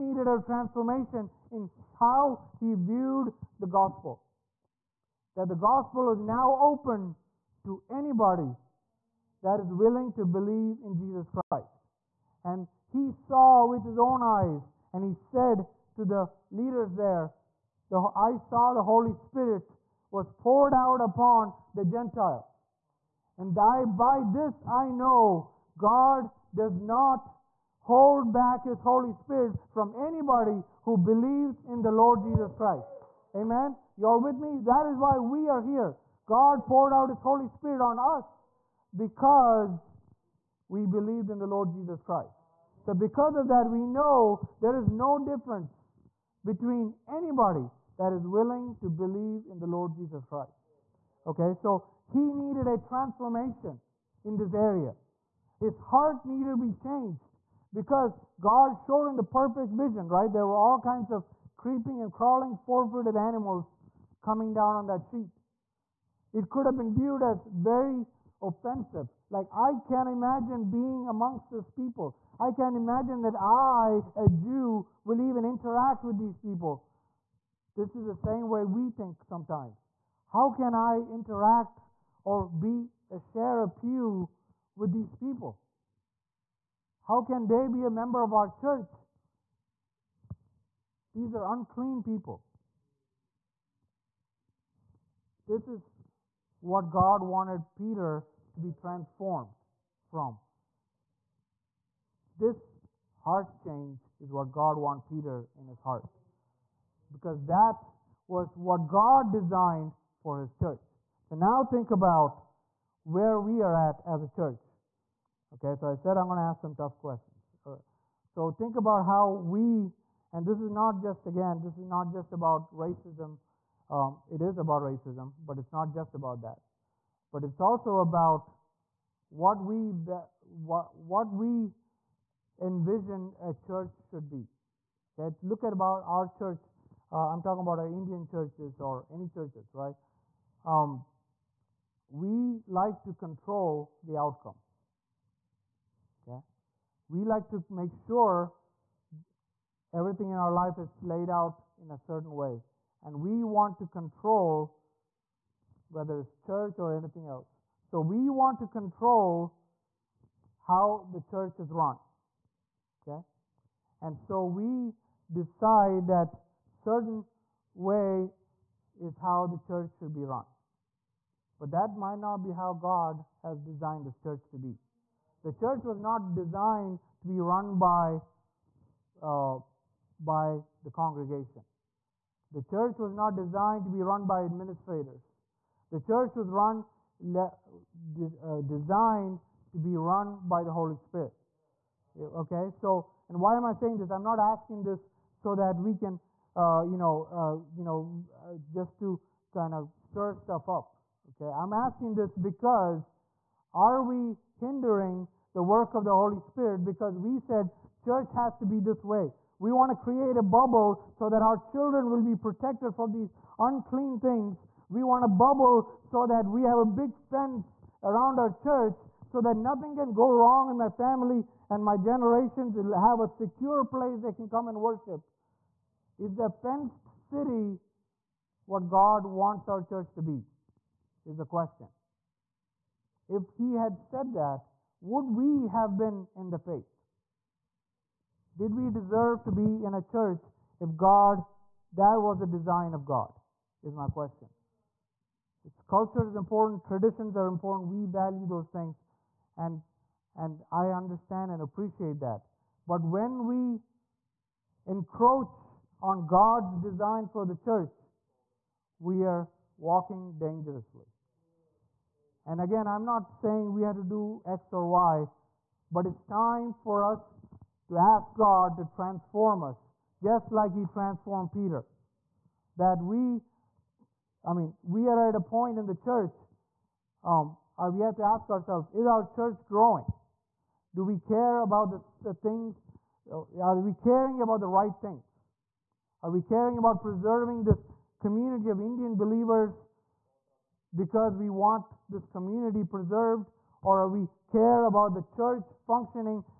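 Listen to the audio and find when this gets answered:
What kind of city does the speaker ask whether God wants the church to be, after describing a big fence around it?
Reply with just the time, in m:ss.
3:46.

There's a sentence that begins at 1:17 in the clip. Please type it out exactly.
This is the same way we think sometimes.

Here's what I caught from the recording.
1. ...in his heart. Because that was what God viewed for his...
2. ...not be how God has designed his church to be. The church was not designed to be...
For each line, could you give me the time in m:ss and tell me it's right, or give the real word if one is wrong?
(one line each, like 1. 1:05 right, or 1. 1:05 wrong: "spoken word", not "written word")
1. 1:45 wrong: "designed", not "viewed"
2. 2:52 right.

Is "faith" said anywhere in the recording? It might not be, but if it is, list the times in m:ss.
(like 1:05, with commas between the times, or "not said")
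3:56.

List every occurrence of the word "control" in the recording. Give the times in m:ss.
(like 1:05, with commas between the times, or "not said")
2:23, 2:33, 2:38.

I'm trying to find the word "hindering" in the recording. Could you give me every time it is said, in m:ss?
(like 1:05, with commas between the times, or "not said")
3:24.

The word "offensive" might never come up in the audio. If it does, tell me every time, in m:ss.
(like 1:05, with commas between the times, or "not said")
1:08.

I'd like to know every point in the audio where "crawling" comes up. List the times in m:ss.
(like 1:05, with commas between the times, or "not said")
1:02.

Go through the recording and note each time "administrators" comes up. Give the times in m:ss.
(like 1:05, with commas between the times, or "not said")
3:04.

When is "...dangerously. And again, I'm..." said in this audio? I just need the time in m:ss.
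4:20.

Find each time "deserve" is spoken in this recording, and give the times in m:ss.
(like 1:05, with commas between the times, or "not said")
3:58.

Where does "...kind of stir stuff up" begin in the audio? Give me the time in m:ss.
3:19.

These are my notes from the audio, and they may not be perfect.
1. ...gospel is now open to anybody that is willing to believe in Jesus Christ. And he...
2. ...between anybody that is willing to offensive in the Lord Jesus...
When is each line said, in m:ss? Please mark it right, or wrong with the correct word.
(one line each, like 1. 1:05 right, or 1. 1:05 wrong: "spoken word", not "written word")
1. 0:05 right
2. 0:46 wrong: "believe", not "offensive".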